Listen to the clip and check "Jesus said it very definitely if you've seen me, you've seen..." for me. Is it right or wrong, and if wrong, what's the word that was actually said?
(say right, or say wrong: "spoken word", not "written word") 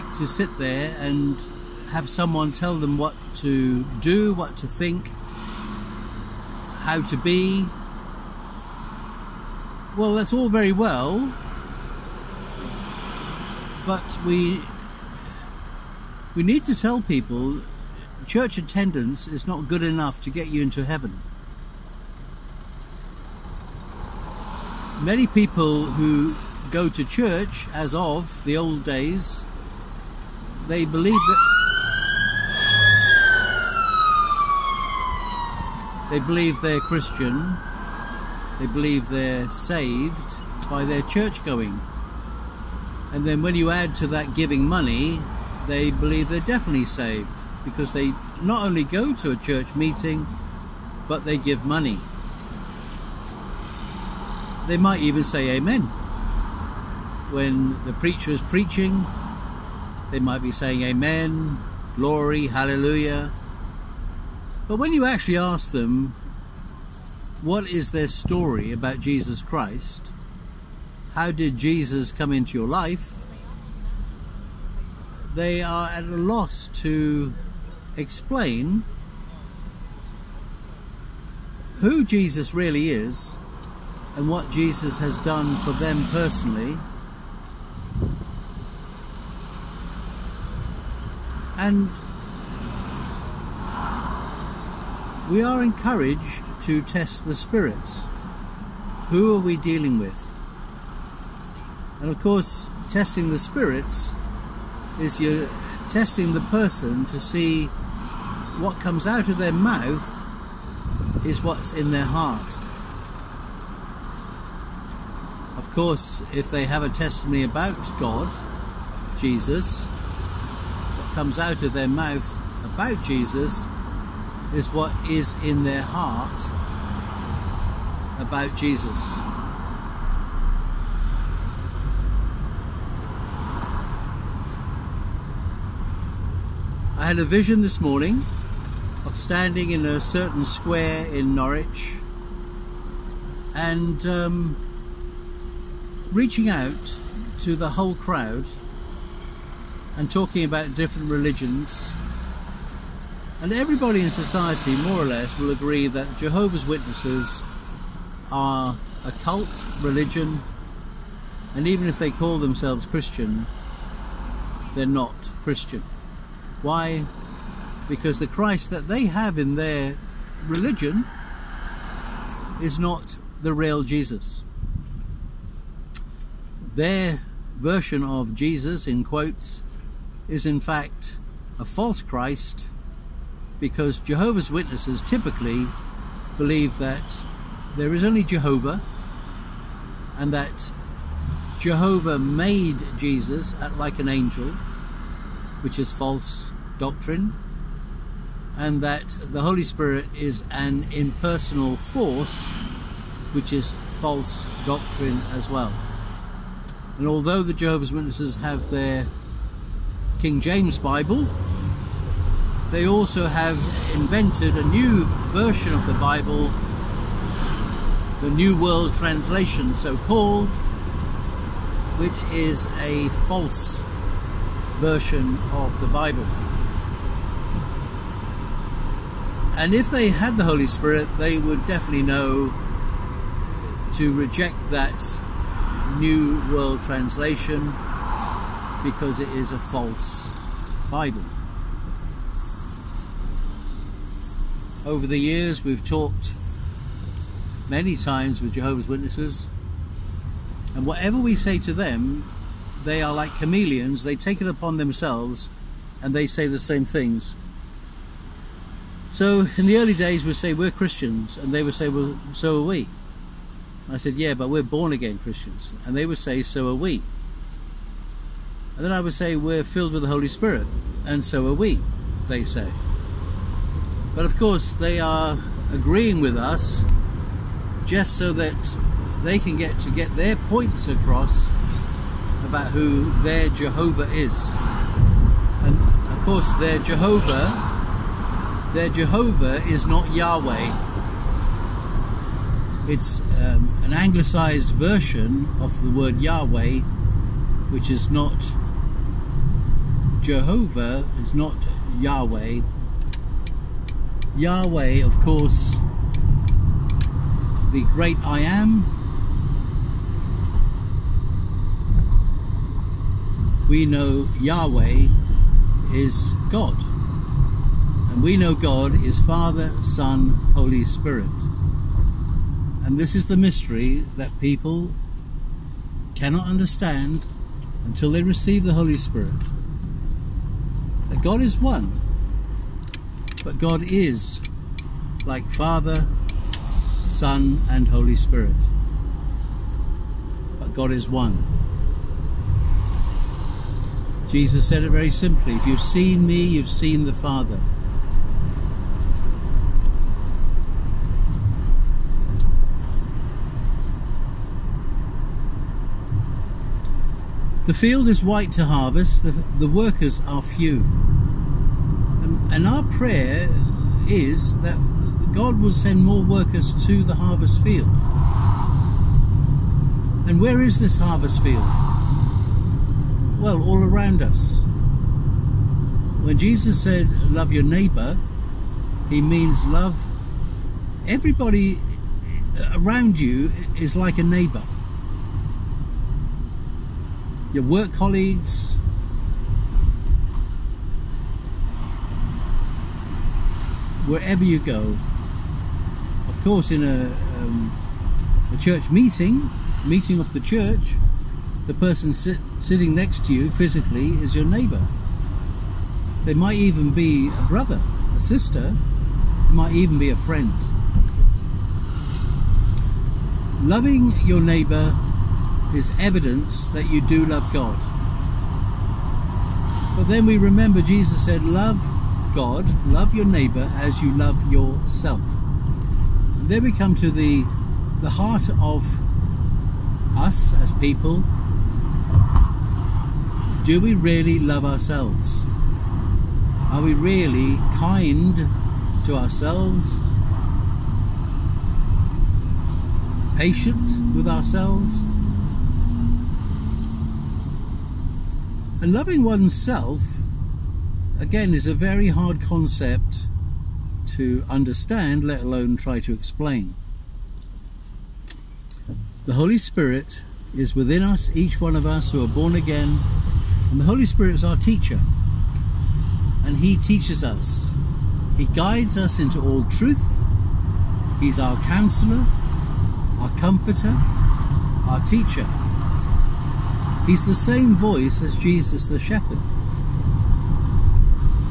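wrong: "simply", not "definitely".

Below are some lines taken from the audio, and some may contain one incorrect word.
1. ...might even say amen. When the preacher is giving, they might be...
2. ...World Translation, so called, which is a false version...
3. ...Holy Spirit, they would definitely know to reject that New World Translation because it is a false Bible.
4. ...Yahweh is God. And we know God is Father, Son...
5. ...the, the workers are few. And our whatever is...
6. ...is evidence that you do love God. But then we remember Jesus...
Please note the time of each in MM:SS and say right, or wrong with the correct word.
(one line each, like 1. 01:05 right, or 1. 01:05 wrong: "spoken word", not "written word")
1. 00:54 wrong: "preaching", not "giving"
2. 03:38 right
3. 03:50 right
4. 05:14 right
5. 05:59 wrong: "prayer", not "whatever"
6. 06:55 right.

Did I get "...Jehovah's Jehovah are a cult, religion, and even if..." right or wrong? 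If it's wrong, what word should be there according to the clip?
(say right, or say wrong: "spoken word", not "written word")
wrong: "Witnesses", not "Jehovah".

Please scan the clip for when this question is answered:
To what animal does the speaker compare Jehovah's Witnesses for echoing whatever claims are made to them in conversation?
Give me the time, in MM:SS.
04:13.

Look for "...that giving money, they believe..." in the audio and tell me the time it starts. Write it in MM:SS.
00:44.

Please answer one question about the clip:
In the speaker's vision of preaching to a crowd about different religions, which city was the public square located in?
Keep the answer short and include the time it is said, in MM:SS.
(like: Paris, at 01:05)
Norwich, at 02:21.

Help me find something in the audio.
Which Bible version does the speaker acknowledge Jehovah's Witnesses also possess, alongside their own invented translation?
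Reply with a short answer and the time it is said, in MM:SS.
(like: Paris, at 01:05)
King James Bible, at 03:30.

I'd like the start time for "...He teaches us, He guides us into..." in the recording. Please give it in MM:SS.
07:46.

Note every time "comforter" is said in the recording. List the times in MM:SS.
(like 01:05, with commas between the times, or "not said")
07:53.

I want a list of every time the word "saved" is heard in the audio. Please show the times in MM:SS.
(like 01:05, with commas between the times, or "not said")
00:39, 00:46.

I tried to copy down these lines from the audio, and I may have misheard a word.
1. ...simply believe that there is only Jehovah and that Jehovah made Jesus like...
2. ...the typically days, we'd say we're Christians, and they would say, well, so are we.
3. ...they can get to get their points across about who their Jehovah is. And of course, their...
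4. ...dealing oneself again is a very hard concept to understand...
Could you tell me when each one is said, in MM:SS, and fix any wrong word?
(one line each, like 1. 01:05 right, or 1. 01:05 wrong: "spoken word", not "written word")
1. 03:05 wrong: "typically", not "simply"
2. 04:19 wrong: "early", not "typically"
3. 04:39 right
4. 07:28 wrong: "loving", not "dealing".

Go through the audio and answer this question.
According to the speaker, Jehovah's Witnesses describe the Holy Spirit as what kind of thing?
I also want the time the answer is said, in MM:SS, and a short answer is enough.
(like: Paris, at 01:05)
An impersonal force, at 03:20.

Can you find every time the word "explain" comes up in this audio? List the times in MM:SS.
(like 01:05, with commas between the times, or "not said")
01:17, 07:36.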